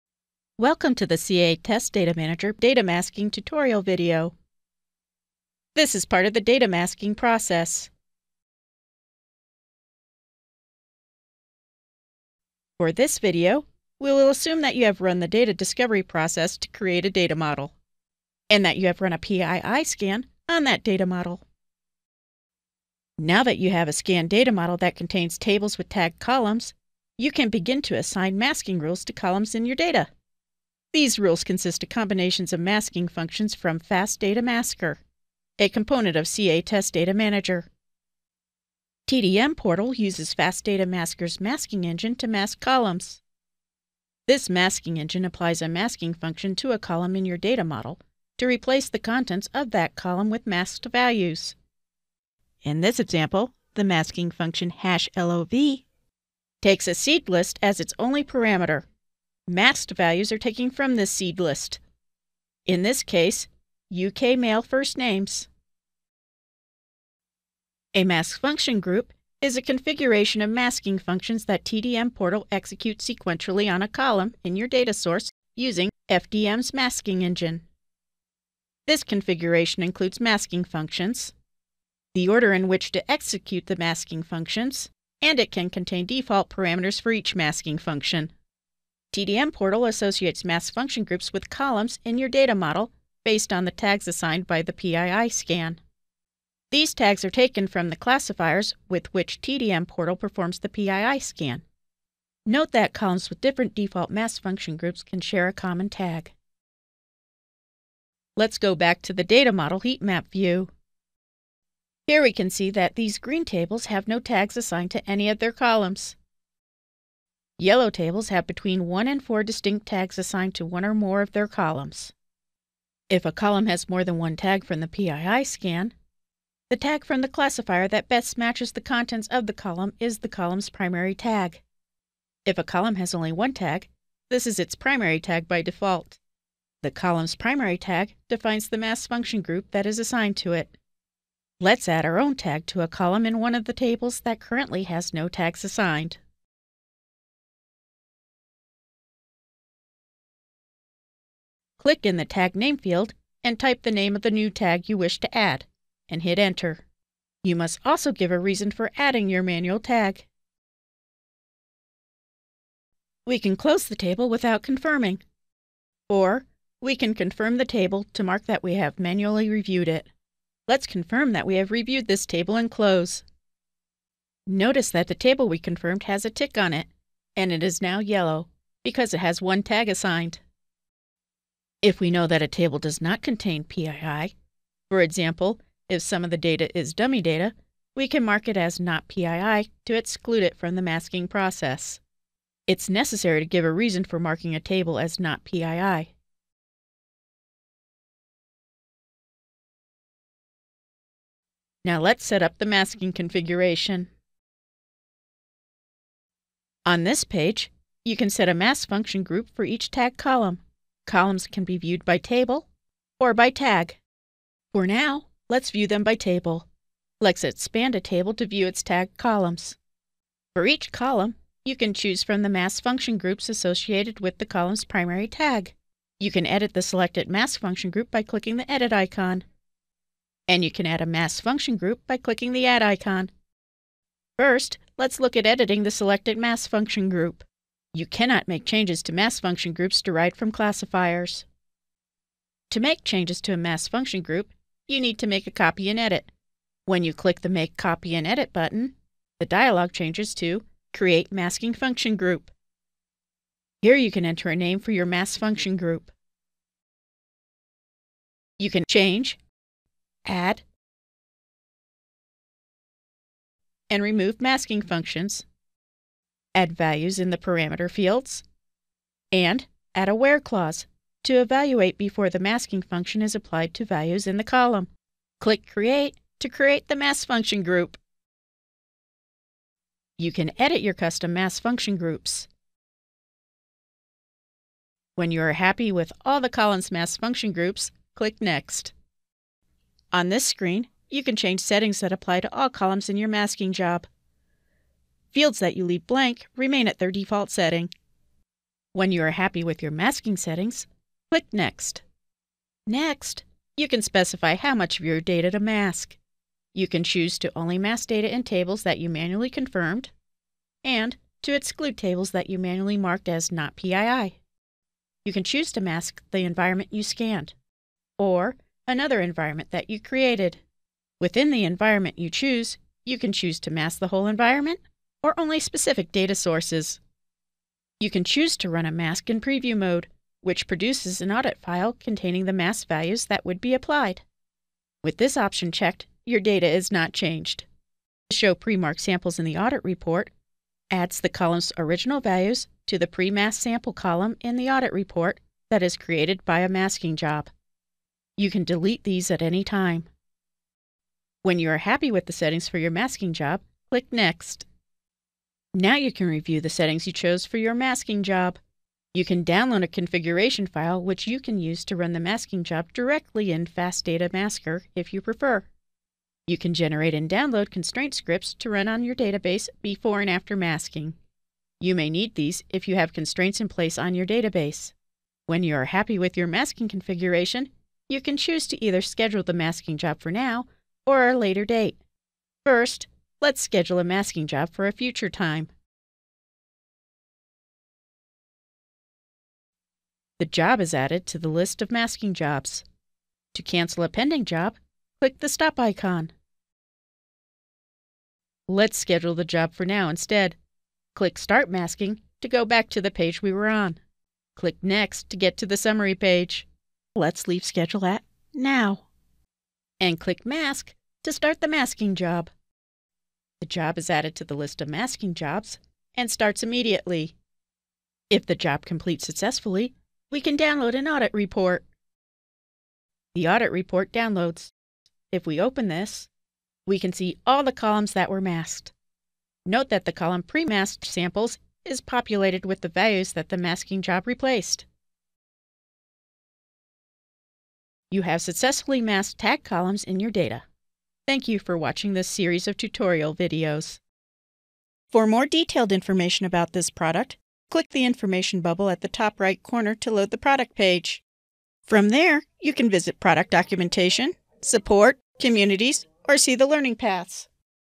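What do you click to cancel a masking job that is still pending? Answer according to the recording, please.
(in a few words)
Stop icon.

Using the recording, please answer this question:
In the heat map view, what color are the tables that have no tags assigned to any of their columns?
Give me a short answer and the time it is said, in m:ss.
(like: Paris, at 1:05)
Green, at 1:53.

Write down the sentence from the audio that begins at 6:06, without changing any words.
You can generate and download constraint scripts to run on your database before and after masking.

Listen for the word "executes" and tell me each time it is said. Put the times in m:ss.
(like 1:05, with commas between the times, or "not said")
1:12, 1:23.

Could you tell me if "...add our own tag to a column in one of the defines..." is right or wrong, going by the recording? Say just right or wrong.
wrong.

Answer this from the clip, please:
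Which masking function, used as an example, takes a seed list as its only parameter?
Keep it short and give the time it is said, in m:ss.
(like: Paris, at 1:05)
hash LOV, at 0:54.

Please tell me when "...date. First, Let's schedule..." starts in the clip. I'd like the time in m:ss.
6:21.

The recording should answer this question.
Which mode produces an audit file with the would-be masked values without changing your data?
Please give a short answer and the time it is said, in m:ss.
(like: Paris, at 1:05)
Preview mode, at 5:29.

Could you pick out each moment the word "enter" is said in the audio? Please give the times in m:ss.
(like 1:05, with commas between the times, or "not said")
2:36, 4:14.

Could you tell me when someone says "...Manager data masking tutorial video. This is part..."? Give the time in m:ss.
0:02.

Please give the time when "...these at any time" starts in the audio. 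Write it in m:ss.
5:49.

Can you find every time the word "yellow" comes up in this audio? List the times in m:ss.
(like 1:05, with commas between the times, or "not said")
1:57, 2:57.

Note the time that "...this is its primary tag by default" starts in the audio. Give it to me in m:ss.
2:14.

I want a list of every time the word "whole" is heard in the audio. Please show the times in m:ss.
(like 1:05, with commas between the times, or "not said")
5:24.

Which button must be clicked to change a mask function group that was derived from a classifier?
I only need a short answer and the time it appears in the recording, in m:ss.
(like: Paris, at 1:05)
Make Copy and Edit, at 4:07.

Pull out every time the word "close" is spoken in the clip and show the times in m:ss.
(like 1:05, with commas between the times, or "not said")
2:43, 2:52.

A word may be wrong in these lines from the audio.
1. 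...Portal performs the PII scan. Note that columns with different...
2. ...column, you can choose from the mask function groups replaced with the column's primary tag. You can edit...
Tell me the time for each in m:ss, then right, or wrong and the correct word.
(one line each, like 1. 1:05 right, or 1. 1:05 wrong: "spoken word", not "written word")
1. 1:39 right
2. 3:40 wrong: "associated", not "replaced".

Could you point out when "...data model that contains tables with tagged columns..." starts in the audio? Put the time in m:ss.
0:24.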